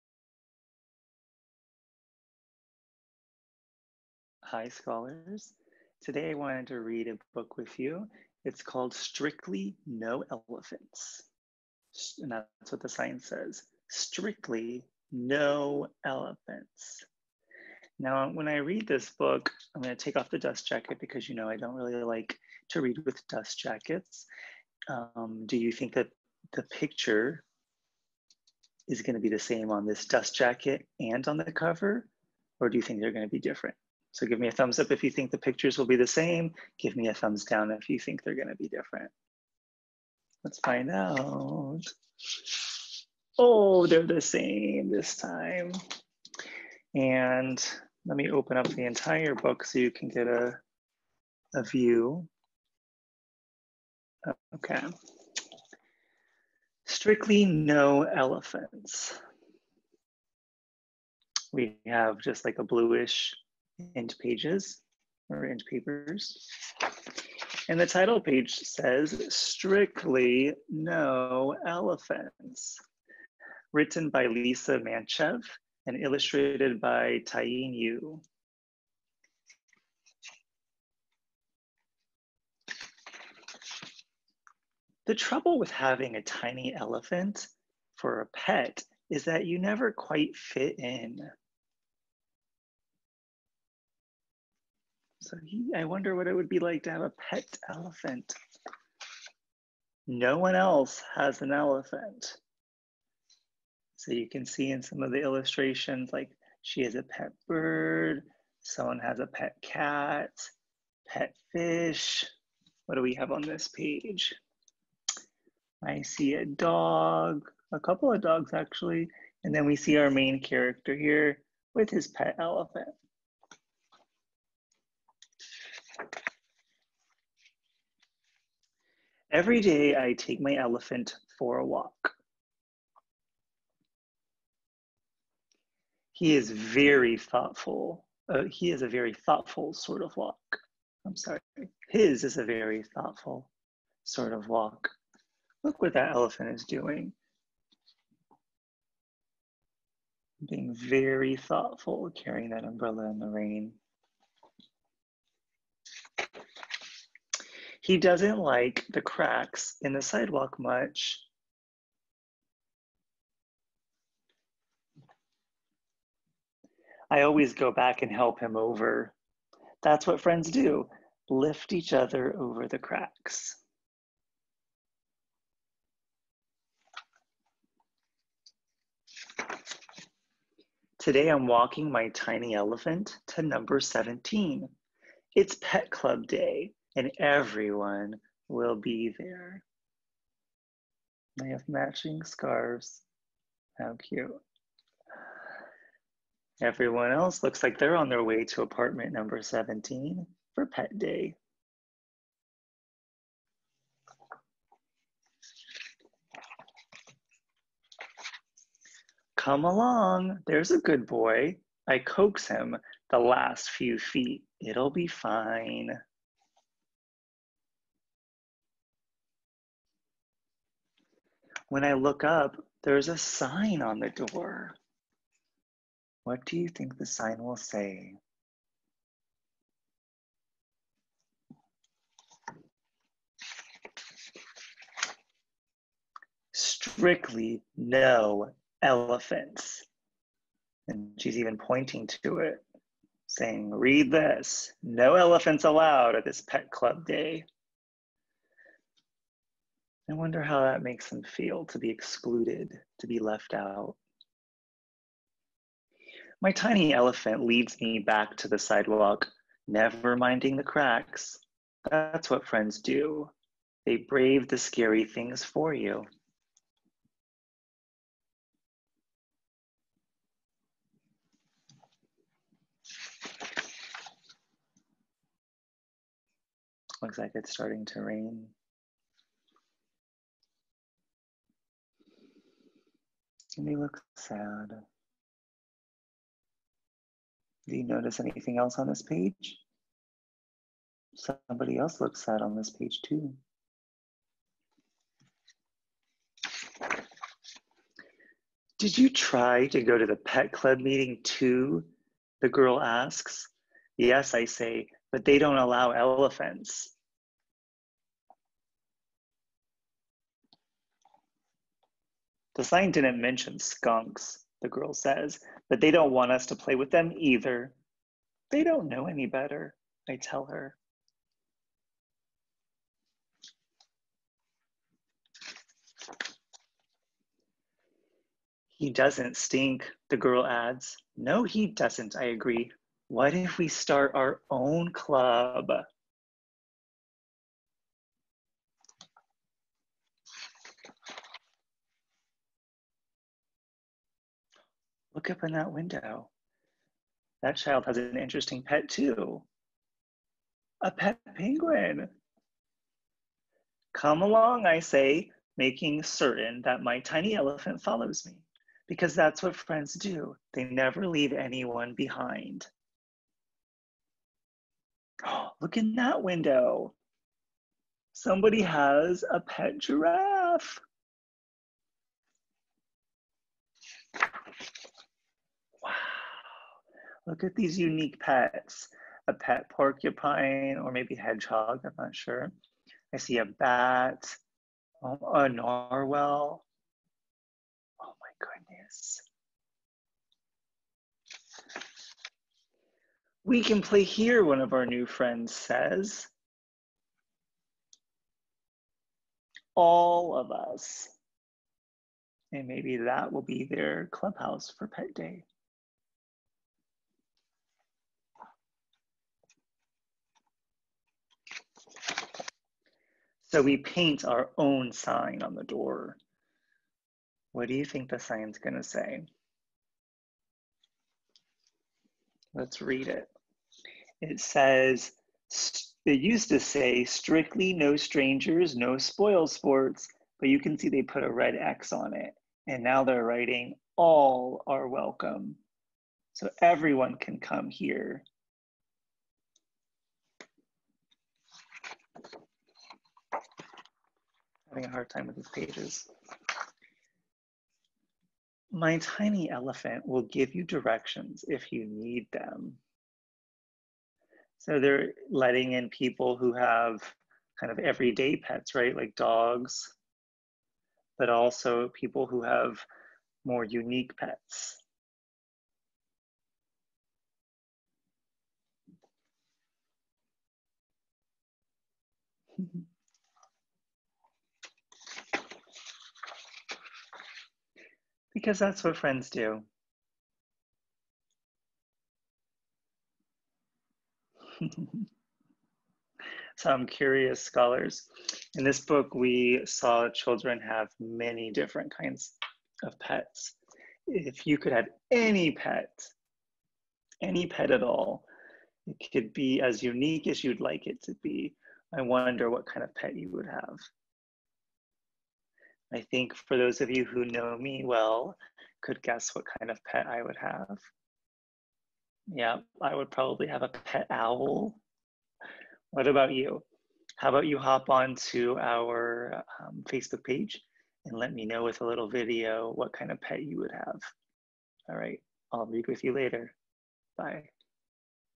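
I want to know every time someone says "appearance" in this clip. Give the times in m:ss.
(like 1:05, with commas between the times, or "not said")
not said.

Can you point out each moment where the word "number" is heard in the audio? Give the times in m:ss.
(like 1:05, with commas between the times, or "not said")
3:03, 3:19.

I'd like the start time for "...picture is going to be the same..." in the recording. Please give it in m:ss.
0:26.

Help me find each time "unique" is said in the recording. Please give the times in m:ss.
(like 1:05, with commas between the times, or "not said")
6:17, 7:43, 8:19.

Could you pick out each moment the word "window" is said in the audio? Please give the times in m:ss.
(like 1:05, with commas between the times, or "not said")
5:45, 6:06.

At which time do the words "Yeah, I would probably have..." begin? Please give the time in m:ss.
8:32.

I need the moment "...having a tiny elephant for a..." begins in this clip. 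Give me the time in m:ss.
1:25.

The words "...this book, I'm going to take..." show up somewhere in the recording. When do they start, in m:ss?
0:18.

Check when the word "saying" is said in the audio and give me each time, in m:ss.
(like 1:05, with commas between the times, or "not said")
4:03.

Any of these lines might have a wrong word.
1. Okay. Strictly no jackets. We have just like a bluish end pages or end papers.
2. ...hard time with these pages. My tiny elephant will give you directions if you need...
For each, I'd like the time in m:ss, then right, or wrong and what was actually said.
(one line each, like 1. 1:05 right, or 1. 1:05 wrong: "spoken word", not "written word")
1. 0:54 wrong: "elephants", not "jackets"
2. 7:24 right.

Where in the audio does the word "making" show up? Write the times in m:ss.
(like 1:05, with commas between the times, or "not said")
4:43, 5:55.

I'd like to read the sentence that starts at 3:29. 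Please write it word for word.
Come along, there's a good boy.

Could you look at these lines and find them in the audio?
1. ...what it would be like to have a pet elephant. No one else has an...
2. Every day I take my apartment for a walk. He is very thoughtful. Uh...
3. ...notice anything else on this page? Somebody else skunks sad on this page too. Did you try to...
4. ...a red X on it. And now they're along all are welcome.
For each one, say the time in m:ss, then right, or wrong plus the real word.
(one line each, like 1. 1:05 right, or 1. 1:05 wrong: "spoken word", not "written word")
1. 1:36 right
2. 2:09 wrong: "elephant", not "apartment"
3. 4:47 wrong: "looks", not "skunks"
4. 7:11 wrong: "writing", not "along".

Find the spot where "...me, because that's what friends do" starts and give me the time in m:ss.
5:58.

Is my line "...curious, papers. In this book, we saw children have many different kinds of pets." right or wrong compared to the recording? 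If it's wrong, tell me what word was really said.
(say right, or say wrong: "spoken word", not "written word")
wrong: "scholars", not "papers".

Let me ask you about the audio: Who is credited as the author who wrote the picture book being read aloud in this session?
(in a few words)
Lisa Mantchev.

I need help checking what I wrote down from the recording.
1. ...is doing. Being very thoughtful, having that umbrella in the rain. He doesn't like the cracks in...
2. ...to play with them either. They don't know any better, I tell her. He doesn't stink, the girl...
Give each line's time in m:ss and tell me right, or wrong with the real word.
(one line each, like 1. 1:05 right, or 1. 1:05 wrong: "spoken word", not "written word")
1. 2:26 wrong: "carrying", not "having"
2. 5:16 right.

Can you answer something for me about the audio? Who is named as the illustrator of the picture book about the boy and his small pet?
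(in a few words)
Taeeun Yoo.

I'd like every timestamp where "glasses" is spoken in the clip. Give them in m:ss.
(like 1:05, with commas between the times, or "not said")
not said.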